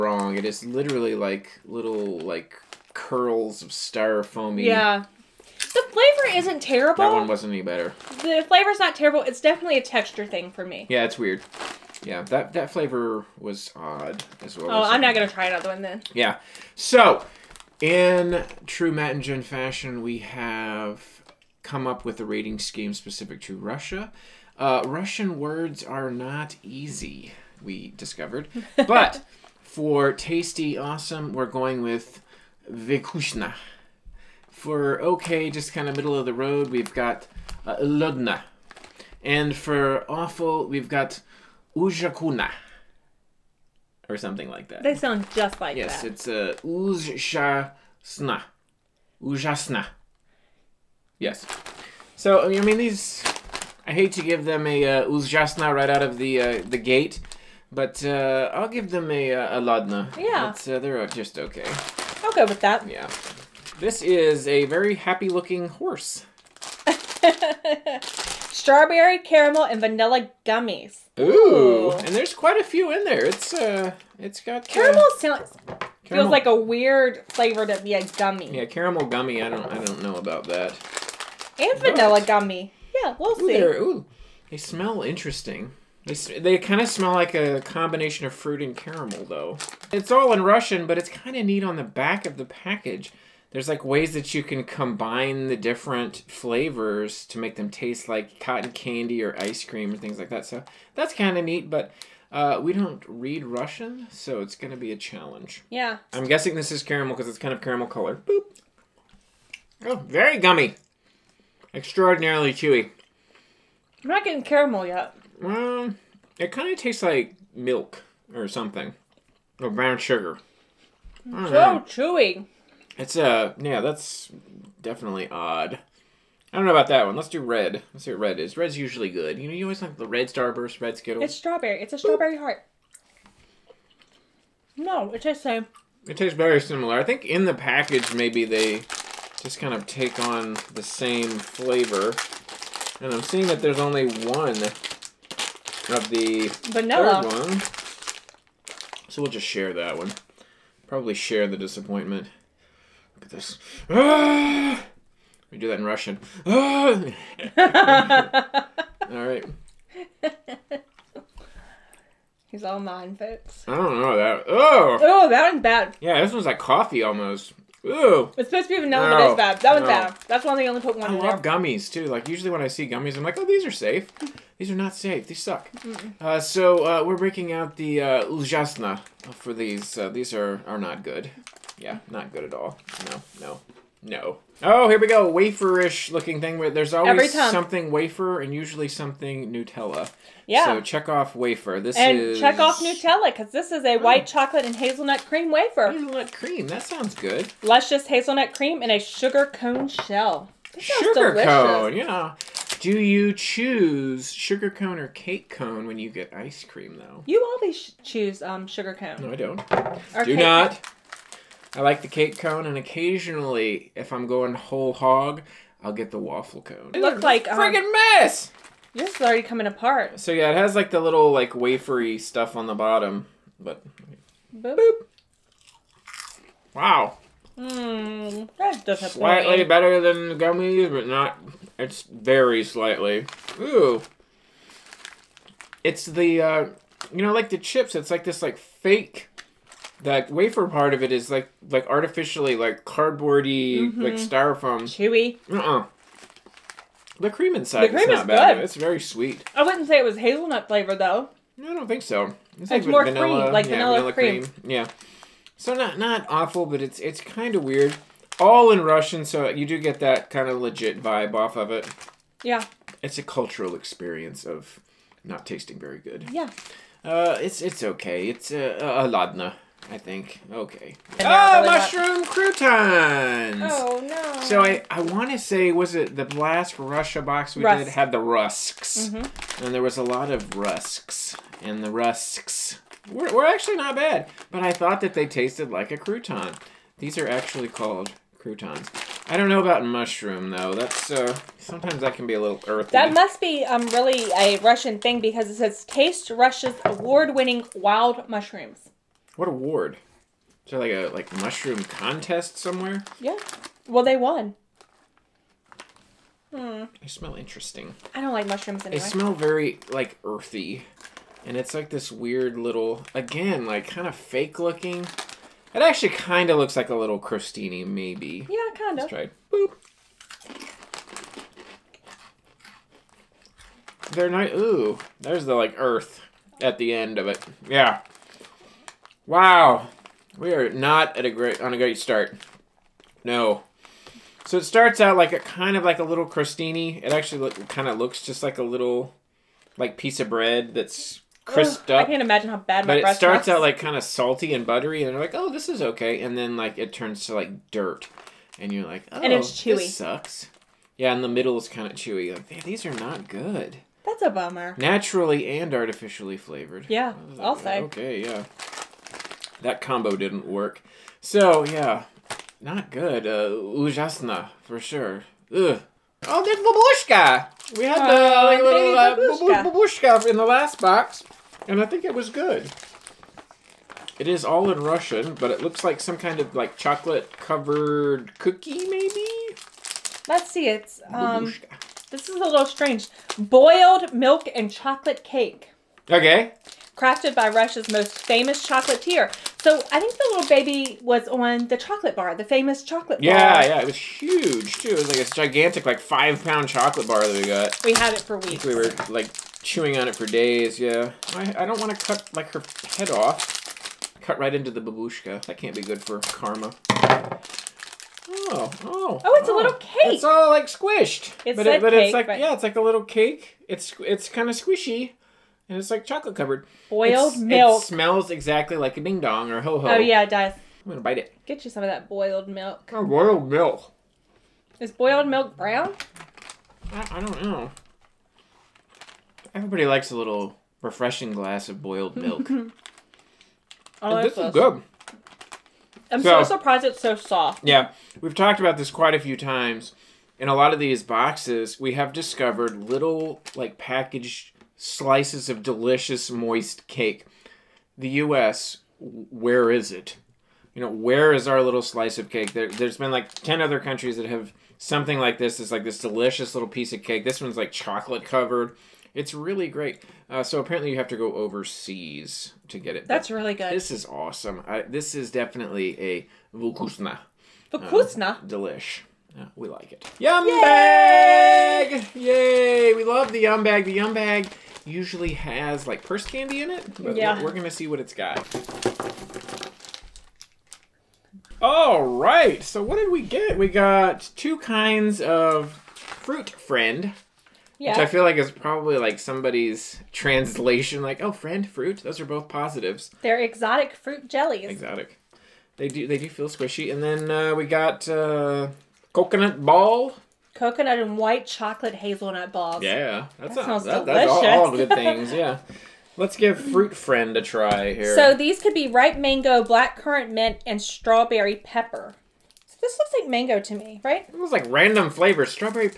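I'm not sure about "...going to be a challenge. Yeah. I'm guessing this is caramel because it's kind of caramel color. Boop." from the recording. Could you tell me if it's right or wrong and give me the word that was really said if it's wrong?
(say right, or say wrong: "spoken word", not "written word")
right.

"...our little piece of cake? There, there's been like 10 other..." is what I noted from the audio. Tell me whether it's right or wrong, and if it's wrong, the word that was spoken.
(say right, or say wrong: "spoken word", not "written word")
wrong: "slice", not "piece".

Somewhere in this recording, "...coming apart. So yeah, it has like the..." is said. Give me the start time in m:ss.
3:39.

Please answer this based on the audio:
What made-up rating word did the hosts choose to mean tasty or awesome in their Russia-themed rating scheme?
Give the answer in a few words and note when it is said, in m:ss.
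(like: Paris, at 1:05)
Vikushna, at 0:32.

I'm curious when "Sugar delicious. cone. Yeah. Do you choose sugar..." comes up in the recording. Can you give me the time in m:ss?
3:20.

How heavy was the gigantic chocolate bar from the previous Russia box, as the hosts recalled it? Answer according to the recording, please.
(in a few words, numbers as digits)
5 pounds.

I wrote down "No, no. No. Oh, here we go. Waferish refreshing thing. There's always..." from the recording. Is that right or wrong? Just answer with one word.
wrong.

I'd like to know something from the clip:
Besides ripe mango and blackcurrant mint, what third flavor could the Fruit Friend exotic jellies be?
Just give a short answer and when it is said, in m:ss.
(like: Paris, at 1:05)
Strawberry pepper, at 8:30.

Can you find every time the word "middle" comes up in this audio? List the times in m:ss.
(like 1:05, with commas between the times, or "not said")
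0:35, 5:51.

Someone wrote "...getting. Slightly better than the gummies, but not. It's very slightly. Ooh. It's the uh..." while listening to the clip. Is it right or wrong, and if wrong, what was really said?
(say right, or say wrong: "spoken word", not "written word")
wrong: "disappointing", not "getting".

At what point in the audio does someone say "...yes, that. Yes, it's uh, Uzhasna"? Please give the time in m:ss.
0:45.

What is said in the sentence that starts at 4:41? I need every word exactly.
And the rusks were, were actually not bad.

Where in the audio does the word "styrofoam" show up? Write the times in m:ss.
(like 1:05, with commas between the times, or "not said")
0:03, 4:04.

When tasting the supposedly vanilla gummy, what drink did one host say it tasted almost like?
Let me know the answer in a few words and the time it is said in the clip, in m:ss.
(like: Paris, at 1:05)
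Coffee, at 2:46.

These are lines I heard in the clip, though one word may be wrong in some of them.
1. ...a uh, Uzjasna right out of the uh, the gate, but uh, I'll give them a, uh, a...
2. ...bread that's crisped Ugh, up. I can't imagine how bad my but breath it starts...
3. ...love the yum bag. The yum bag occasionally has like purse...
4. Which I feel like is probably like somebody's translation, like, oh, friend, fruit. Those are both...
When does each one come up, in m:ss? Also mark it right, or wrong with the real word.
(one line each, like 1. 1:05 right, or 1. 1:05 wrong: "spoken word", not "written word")
1. 0:54 right
2. 5:40 right
3. 7:53 wrong: "usually", not "occasionally"
4. 8:07 right.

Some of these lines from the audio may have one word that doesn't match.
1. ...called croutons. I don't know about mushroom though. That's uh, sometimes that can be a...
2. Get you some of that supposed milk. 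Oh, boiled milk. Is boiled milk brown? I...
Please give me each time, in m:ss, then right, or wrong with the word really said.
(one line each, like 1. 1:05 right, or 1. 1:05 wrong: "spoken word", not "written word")
1. 4:47 right
2. 7:01 wrong: "boiled", not "supposed".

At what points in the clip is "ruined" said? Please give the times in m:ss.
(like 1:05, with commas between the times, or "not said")
not said.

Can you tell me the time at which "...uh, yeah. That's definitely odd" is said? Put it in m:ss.
2:03.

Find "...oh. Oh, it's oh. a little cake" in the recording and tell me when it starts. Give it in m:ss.
6:48.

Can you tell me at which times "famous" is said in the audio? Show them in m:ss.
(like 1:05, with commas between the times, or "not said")
6:28, 6:32.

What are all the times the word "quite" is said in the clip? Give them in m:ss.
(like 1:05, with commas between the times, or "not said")
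1:12, 7:18.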